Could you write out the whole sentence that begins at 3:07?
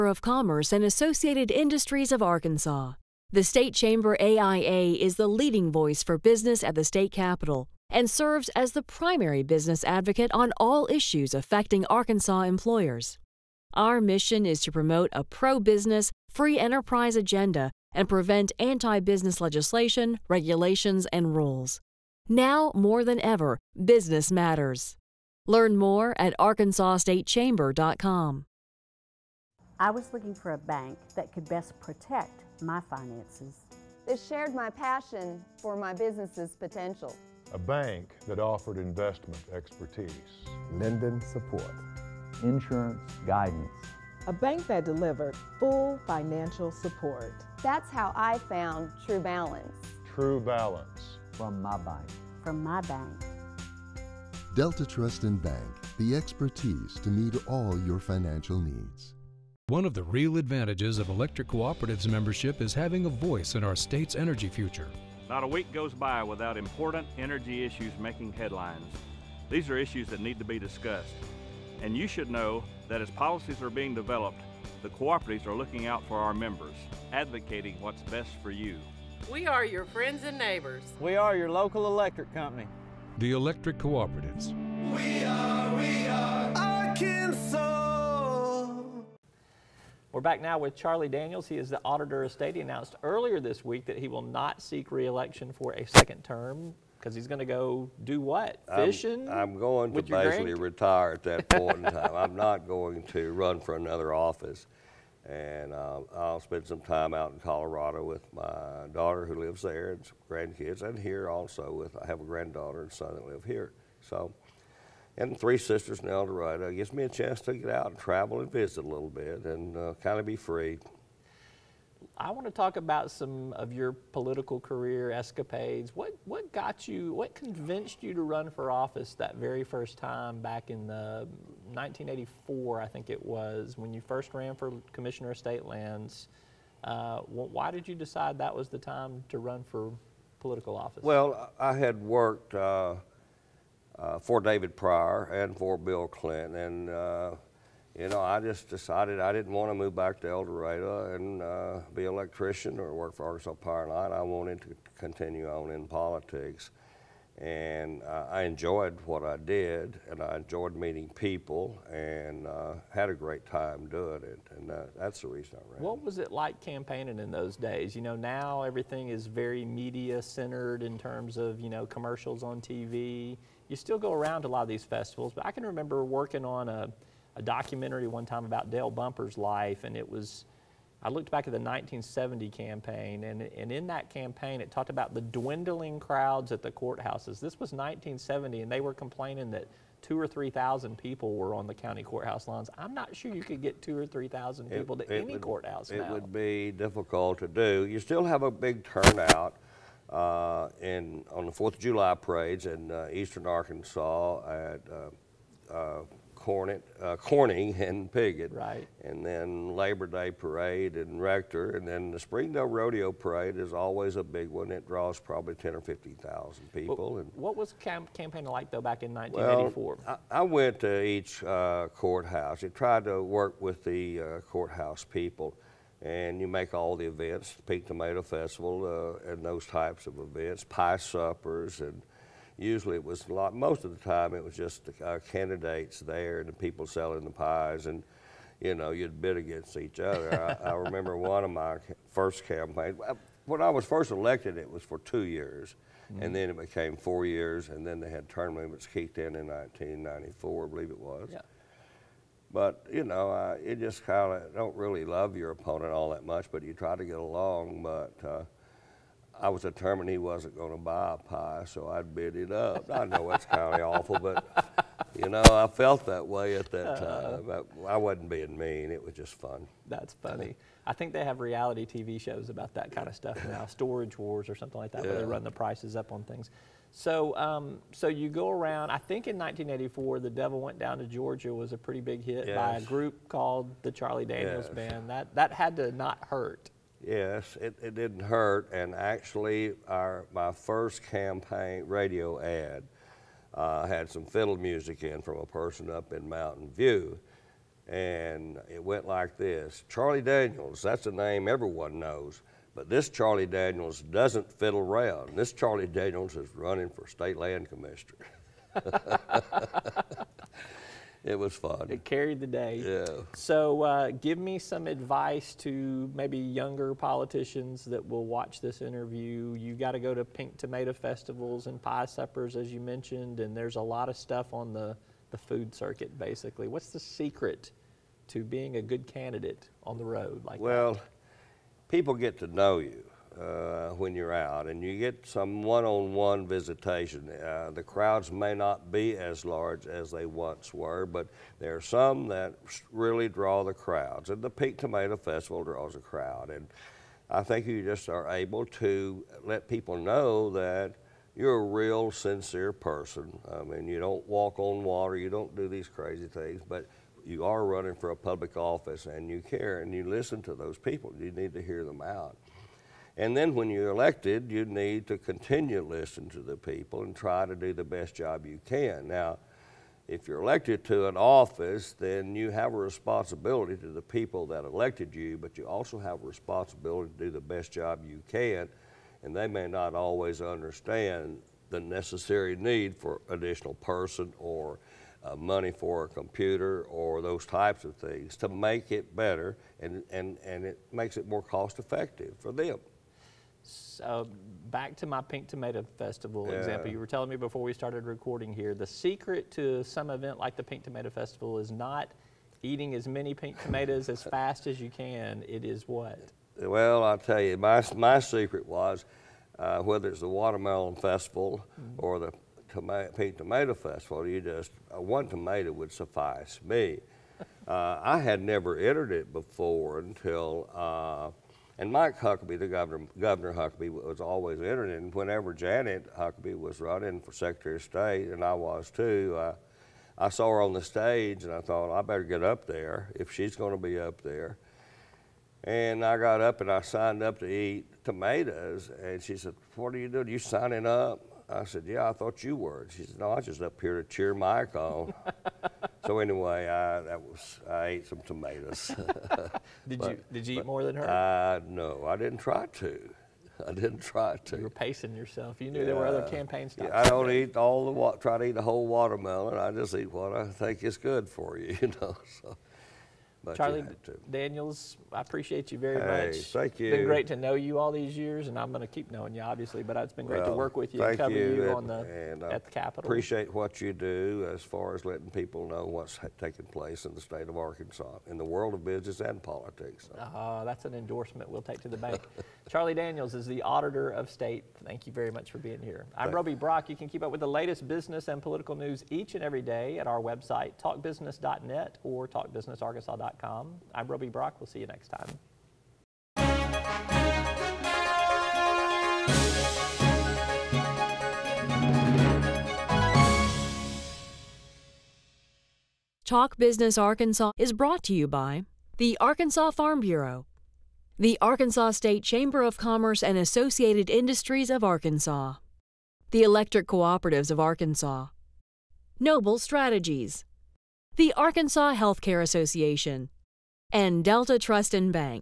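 This was 1970, and they were complaining that two or 3,000 people were on the county courthouse lines.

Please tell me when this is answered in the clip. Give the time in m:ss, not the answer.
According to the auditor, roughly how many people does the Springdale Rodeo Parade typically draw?
3:35.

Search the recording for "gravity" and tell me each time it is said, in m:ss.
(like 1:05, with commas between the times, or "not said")
not said.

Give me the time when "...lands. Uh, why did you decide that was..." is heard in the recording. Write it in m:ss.
2:15.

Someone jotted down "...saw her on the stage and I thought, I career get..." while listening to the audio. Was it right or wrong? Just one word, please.
wrong.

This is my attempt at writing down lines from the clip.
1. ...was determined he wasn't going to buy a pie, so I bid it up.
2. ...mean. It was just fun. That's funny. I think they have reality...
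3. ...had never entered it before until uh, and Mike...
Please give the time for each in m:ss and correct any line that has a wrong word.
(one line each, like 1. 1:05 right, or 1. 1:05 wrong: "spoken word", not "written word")
1. 4:19 right
2. 4:28 right
3. 6:58 right.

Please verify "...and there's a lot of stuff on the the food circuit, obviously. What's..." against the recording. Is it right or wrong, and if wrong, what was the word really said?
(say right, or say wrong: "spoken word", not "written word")
wrong: "basically", not "obviously".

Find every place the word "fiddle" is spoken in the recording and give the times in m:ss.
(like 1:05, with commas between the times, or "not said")
4:54, 5:04.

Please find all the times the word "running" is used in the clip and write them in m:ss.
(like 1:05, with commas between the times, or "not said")
5:06, 5:57, 7:06.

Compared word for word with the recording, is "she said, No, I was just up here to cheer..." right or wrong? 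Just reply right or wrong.
right.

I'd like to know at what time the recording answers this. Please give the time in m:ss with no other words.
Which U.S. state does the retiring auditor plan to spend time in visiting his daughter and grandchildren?
1:47.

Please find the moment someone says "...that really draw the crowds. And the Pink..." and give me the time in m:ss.
5:42.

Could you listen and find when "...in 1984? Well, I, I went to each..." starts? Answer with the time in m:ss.
3:39.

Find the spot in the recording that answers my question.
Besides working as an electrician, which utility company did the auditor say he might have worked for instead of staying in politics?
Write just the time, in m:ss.
2:33.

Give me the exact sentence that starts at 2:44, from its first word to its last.
And that's the reason I ran.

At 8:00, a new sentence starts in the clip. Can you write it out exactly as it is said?
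Uh, that's an endorsement we'll take to the bank.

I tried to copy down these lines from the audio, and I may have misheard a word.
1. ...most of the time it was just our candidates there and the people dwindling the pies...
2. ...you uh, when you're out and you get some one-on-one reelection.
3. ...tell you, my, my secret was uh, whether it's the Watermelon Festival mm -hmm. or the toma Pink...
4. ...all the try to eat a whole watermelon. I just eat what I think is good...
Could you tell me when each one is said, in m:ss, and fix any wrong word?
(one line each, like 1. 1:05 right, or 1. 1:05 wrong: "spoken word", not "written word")
1. 3:53 wrong: "selling", not "dwindling"
2. 5:32 wrong: "visitation", not "reelection"
3. 6:47 right
4. 7:37 right.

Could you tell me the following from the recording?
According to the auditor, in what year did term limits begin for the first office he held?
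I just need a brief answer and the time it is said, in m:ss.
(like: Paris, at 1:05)
1994, at 4:09.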